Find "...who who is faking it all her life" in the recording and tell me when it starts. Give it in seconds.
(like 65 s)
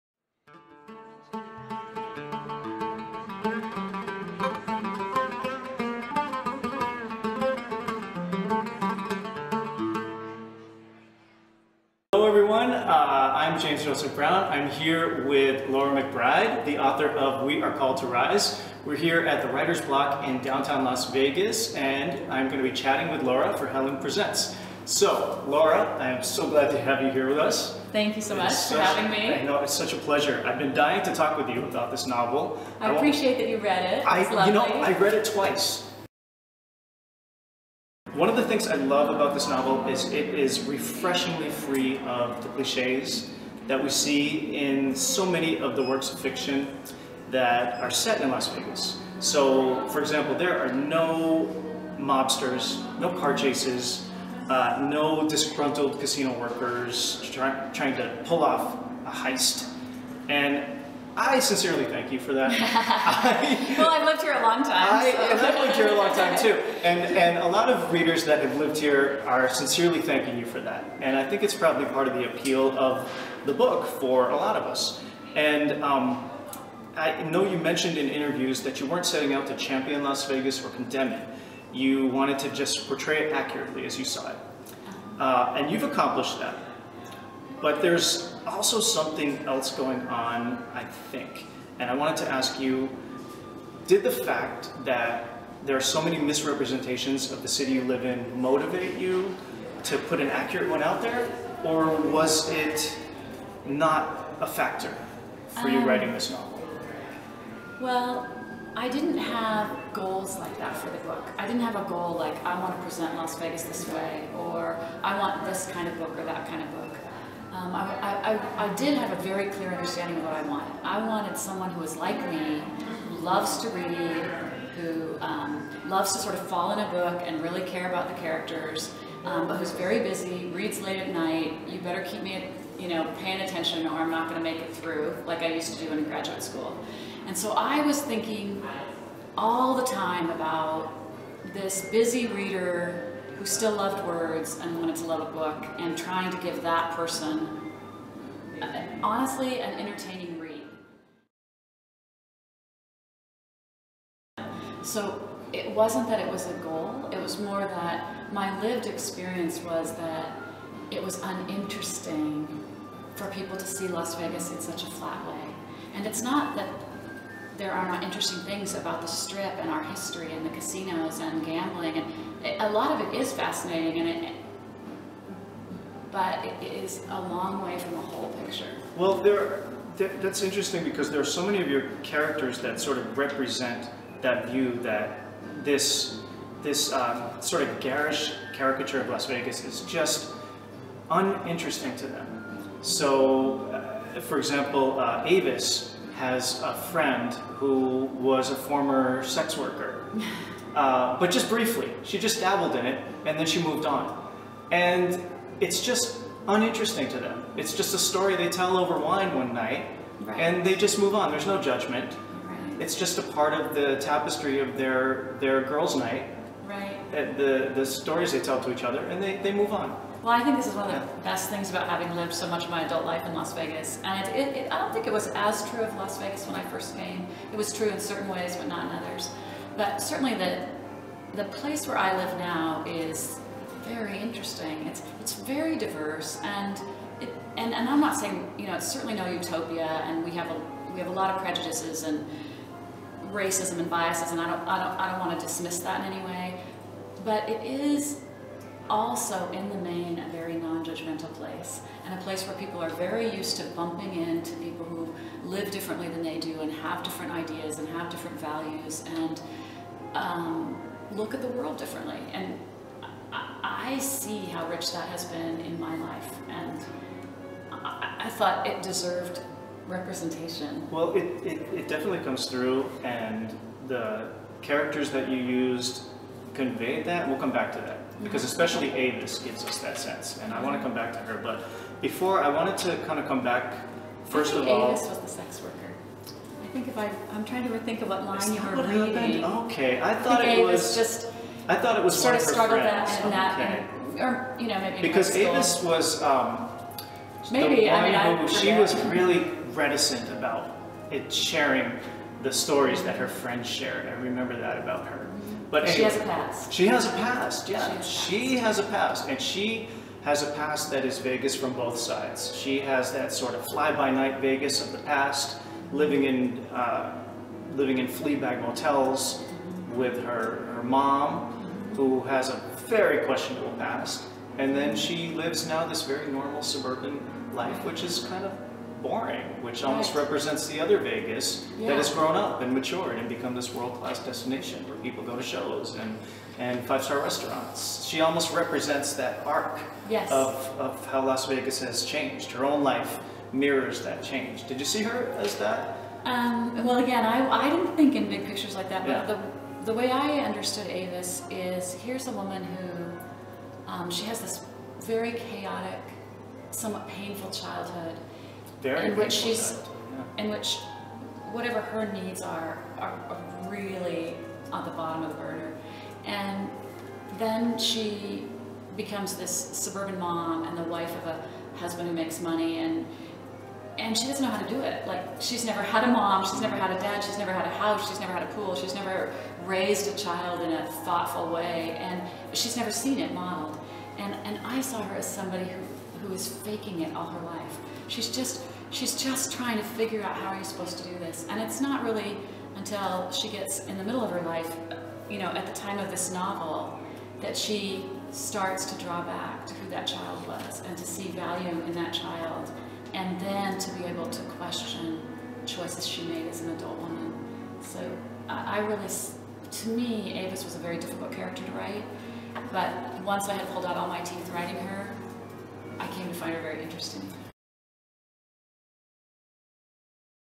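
385 s.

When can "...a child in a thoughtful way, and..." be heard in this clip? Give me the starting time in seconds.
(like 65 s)
380 s.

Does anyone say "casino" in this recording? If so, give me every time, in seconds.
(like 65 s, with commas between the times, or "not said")
55 s, 170 s.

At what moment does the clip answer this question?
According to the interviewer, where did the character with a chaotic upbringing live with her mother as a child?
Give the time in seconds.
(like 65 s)
318 s.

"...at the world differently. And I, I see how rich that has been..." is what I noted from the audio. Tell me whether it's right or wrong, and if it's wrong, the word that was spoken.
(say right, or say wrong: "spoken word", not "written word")
right.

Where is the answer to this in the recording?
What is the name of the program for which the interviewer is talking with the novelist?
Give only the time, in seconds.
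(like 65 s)
23 s.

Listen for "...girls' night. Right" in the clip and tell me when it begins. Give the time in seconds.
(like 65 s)
215 s.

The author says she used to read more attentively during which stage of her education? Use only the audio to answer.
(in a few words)
Graduate school.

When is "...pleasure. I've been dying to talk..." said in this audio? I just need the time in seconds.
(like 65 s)
29 s.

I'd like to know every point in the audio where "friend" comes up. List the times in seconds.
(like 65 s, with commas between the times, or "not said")
196 s, 303 s.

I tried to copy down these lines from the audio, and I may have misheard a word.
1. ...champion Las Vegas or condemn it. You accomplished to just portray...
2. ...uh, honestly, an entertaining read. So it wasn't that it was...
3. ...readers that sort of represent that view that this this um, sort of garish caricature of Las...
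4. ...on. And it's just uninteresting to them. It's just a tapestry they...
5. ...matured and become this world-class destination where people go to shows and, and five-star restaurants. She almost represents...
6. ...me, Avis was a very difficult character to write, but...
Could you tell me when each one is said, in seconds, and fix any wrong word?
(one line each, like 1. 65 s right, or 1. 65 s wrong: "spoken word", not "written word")
1. 79 s wrong: "wanted", not "accomplished"
2. 148 s right
3. 182 s wrong: "characters", not "readers"
4. 203 s wrong: "story", not "tapestry"
5. 332 s right
6. 409 s right.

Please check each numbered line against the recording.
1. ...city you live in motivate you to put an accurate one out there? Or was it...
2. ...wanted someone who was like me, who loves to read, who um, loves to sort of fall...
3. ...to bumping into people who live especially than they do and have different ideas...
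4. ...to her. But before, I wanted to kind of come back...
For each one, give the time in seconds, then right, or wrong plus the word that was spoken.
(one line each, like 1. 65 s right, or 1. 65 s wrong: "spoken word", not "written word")
1. 97 s right
2. 121 s right
3. 253 s wrong: "differently", not "especially"
4. 281 s right.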